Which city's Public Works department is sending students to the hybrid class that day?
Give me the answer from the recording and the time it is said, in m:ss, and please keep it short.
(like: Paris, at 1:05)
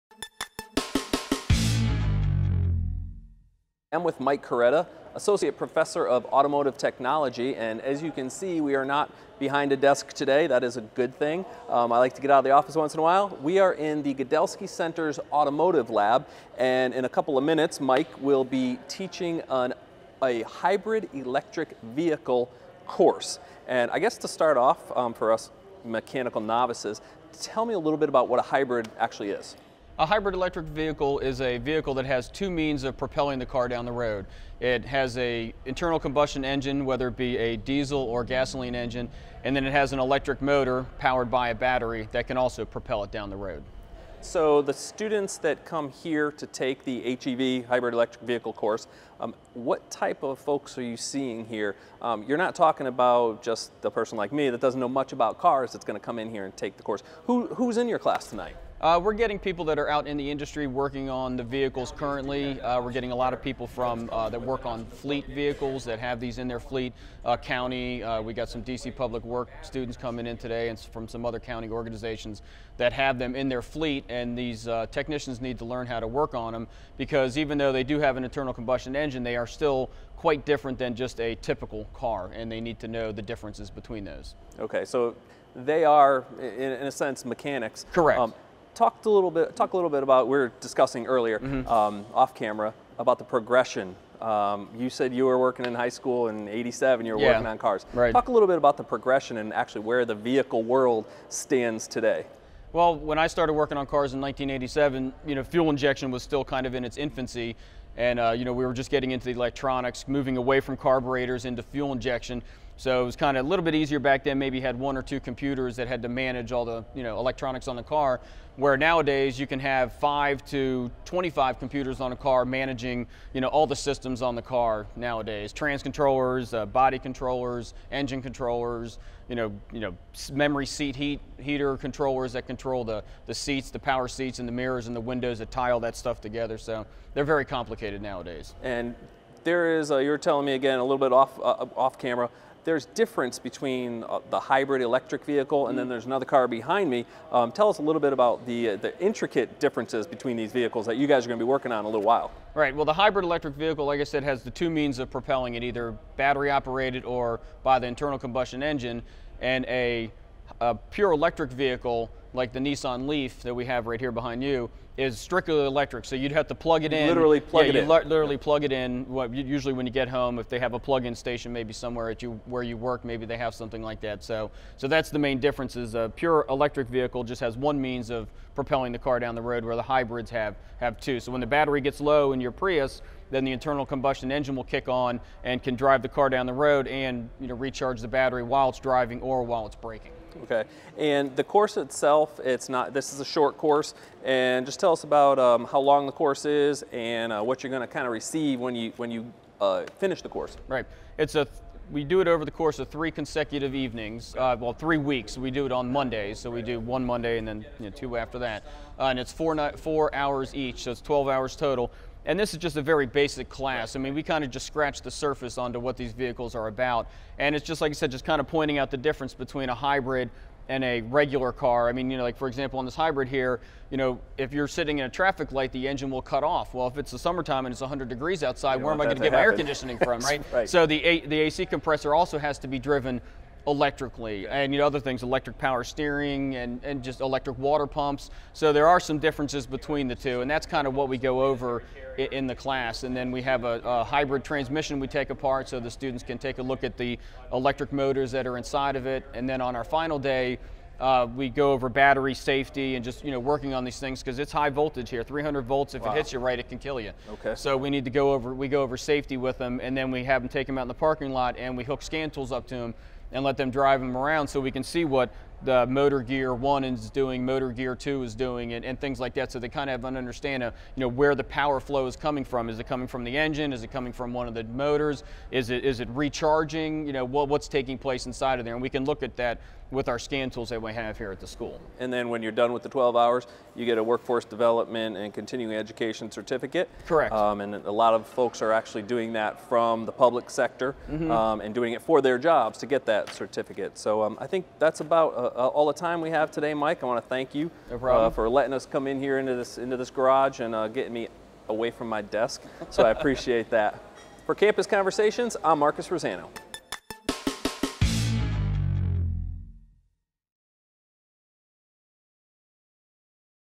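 DC, at 1:08.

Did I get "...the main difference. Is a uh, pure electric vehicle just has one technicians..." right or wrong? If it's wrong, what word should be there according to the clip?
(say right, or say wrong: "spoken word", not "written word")
wrong: "means", not "technicians".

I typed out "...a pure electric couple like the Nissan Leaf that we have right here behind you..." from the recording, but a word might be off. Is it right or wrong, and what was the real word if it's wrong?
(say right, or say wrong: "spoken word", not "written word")
wrong: "vehicle", not "couple".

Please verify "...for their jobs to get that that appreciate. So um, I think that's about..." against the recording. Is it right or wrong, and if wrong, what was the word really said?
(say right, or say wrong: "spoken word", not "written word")
wrong: "certificate", not "appreciate".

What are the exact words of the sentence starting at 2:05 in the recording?
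Trans controllers, uh, body controllers, engine controllers.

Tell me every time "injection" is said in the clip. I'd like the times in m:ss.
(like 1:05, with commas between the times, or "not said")
1:45, 1:51.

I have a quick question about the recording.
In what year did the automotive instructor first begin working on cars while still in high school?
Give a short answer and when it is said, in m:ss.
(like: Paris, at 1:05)
1987, at 1:44.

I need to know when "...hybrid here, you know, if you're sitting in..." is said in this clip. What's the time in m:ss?
3:42.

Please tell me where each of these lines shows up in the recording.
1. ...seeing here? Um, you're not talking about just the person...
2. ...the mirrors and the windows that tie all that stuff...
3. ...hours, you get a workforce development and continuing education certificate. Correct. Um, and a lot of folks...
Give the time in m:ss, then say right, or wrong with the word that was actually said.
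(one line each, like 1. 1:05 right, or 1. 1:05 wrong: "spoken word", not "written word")
1. 0:50 right
2. 2:14 right
3. 4:43 right.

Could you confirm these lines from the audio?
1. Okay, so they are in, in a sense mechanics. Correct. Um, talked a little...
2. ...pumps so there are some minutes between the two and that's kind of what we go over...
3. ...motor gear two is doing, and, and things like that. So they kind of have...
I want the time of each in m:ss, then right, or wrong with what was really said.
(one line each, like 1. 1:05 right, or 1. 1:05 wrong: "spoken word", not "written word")
1. 1:24 right
2. 3:57 wrong: "differences", not "minutes"
3. 4:27 right.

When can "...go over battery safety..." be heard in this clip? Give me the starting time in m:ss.
4:11.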